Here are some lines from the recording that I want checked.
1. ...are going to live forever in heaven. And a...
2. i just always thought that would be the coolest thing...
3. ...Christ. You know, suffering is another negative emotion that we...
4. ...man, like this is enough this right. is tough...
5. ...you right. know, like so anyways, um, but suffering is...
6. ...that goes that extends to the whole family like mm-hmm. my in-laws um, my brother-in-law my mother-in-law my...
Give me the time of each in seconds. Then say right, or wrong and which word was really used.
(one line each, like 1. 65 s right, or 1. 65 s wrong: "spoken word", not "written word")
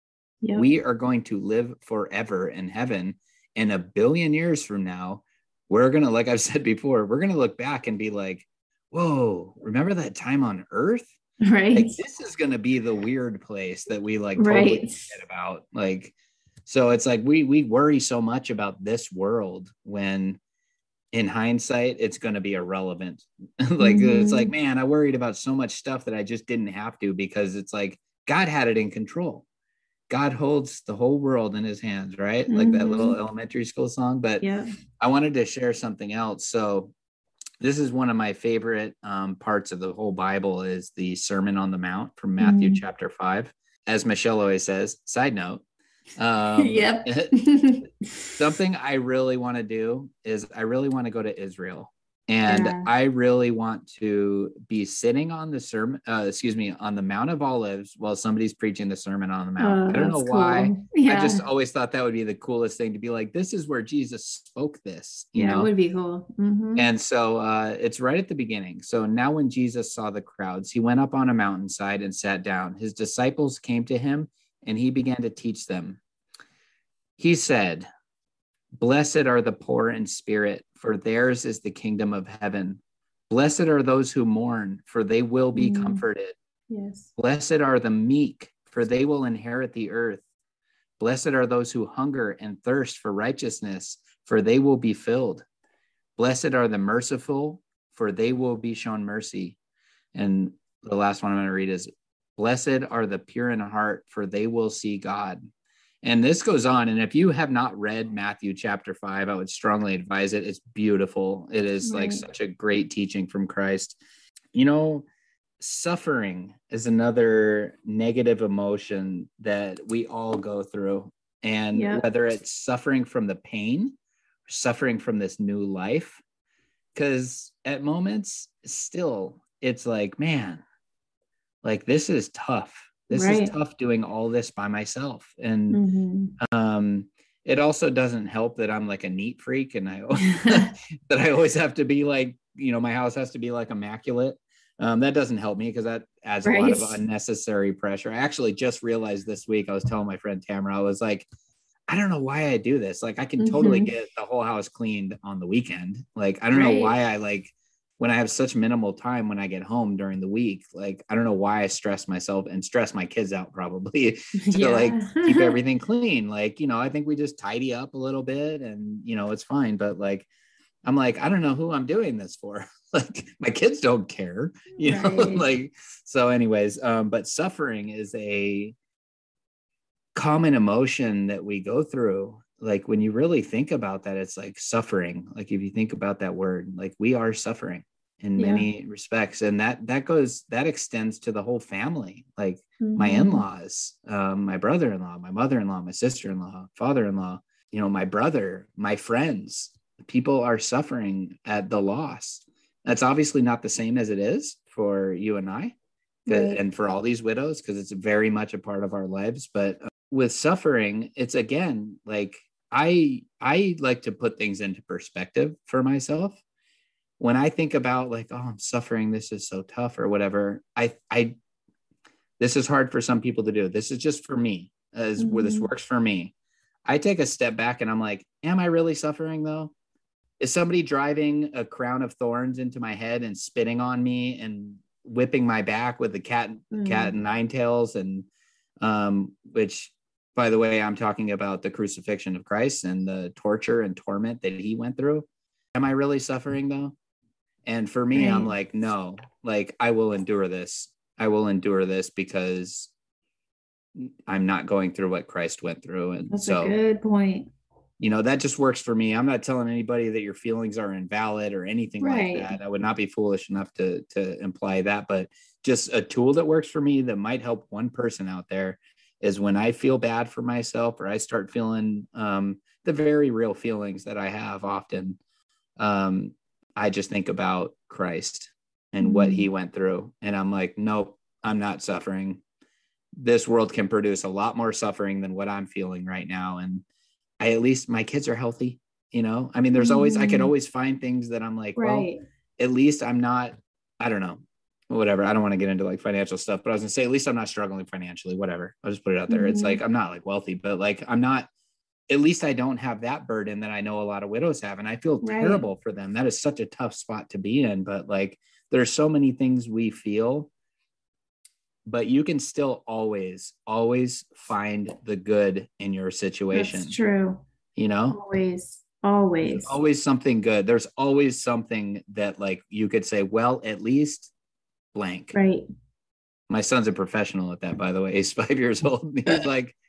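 1. 0 s right
2. 61 s right
3. 113 s right
4. 130 s wrong: "tough", not "enough"
5. 174 s right
6. 189 s right.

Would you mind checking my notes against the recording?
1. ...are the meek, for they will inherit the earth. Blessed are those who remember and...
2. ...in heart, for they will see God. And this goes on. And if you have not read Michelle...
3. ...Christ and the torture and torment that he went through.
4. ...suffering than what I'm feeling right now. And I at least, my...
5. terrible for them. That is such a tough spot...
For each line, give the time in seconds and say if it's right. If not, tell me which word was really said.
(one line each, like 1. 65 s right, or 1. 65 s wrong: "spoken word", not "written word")
1. 87 s wrong: "hunger", not "remember"
2. 103 s wrong: "Matthew", not "Michelle"
3. 242 s right
4. 284 s right
5. 305 s right.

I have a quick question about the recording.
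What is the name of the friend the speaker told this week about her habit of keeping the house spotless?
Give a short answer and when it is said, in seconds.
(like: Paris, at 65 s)
Tamara, at 150 s.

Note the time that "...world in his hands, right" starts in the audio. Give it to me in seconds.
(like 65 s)
31 s.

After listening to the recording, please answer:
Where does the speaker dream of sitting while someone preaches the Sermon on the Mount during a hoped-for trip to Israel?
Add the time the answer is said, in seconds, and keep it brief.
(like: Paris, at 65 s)
Mount of Olives, at 57 s.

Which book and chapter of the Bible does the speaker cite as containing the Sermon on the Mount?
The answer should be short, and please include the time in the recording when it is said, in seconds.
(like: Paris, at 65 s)
Matthew chapter 5, at 42 s.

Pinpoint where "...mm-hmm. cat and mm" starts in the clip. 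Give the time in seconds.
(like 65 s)
236 s.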